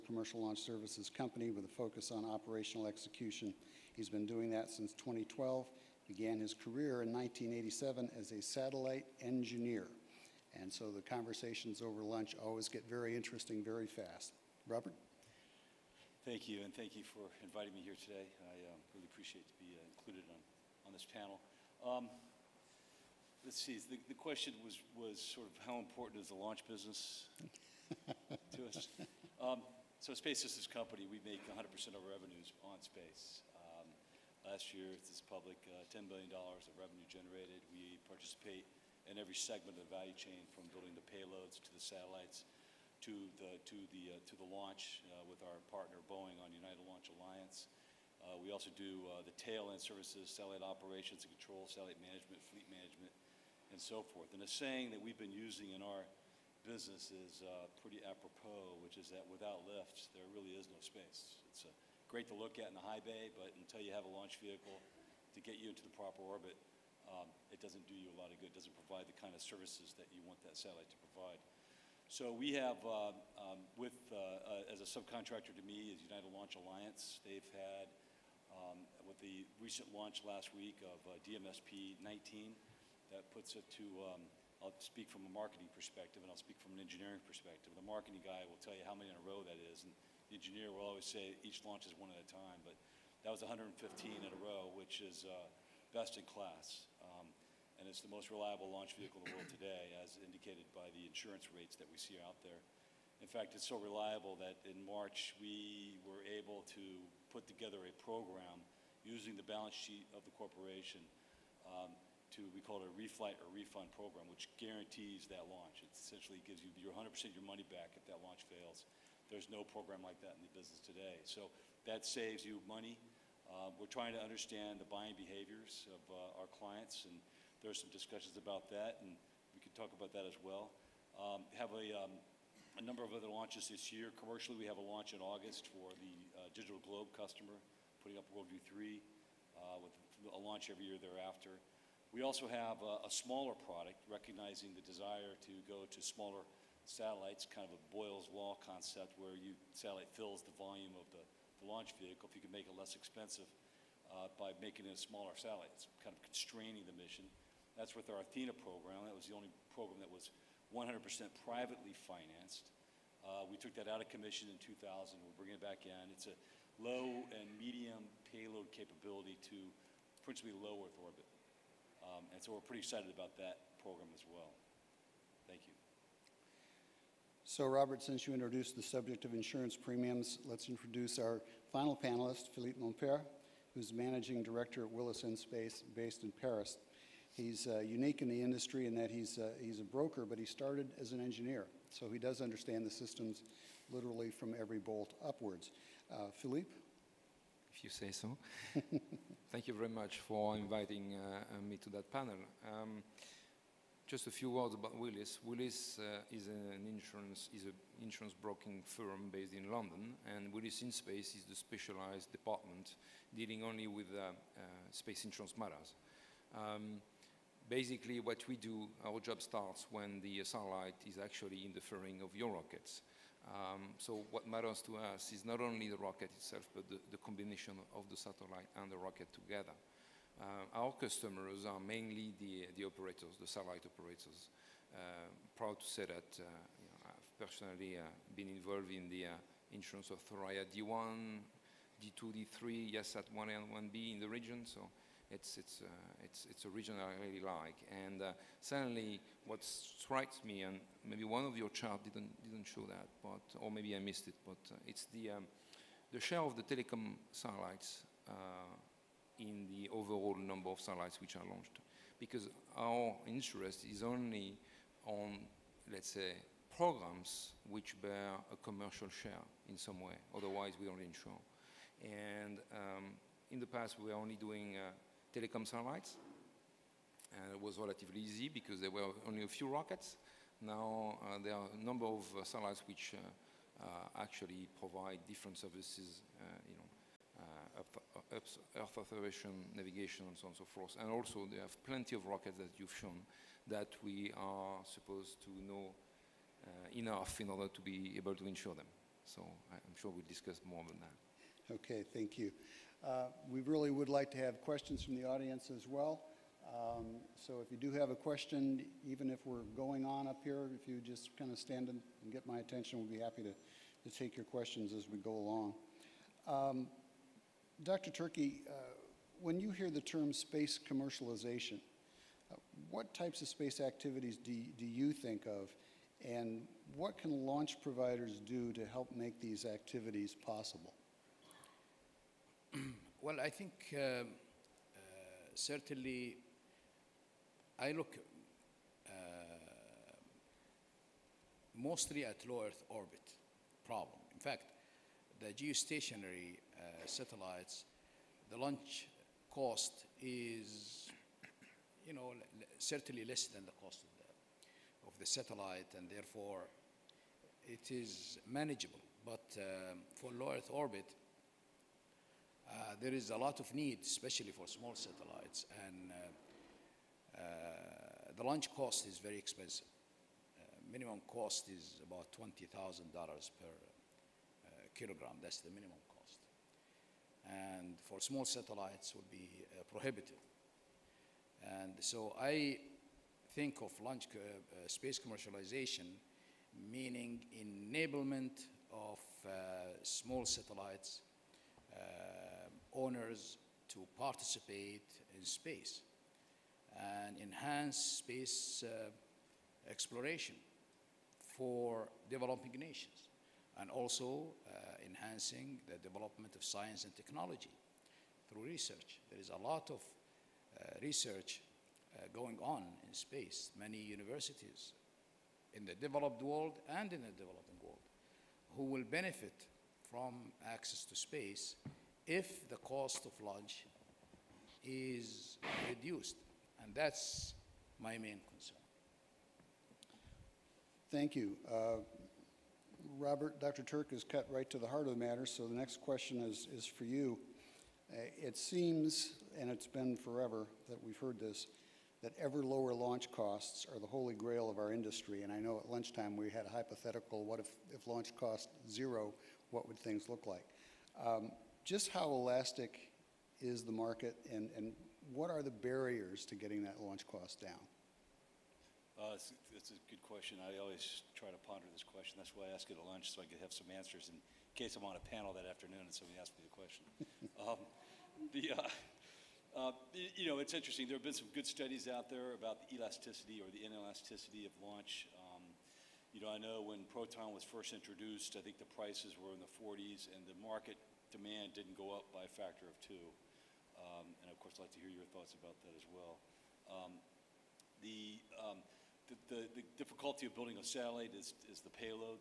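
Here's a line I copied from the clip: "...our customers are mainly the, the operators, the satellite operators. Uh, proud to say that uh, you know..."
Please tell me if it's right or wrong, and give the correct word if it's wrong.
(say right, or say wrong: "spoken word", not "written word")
right.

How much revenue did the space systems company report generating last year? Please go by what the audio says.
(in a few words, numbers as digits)
$10 billion.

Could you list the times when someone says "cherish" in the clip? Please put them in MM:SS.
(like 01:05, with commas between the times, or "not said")
not said.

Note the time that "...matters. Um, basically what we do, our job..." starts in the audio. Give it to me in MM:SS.
03:35.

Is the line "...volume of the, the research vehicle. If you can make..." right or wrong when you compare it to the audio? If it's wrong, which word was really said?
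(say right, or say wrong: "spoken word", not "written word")
wrong: "launch", not "research".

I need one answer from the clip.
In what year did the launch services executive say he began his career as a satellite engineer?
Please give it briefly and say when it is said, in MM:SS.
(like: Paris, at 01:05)
1987, at 00:07.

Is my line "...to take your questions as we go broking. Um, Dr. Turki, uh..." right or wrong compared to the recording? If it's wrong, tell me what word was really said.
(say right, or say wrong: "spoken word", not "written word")
wrong: "along", not "broking".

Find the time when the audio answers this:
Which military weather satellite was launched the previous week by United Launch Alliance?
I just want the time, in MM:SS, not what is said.
01:21.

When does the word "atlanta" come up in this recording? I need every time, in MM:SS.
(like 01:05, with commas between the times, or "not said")
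not said.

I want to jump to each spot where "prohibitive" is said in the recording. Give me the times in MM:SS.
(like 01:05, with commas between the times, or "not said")
06:19.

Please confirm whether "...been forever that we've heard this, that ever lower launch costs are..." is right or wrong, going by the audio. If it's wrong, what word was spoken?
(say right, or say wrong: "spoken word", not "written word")
right.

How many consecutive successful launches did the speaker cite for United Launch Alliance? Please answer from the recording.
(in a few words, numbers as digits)
115.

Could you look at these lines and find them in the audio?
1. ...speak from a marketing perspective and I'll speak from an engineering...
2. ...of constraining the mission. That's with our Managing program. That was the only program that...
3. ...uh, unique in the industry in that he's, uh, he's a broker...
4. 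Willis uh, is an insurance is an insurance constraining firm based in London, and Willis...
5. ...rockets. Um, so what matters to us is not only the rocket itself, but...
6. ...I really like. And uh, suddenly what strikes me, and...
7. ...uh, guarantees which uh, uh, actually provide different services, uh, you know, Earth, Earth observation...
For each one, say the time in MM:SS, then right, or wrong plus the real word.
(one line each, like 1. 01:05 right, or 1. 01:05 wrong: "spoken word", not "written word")
1. 01:24 right
2. 02:36 wrong: "Athena", not "Managing"
3. 03:07 right
4. 03:25 wrong: "broking", not "constraining"
5. 03:42 right
6. 04:06 right
7. 04:42 wrong: "satellites", not "guarantees".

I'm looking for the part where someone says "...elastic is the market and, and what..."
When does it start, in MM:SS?
07:32.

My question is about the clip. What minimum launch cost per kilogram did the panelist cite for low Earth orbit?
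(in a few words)
$20,000.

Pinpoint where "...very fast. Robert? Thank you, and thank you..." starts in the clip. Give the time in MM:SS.
00:13.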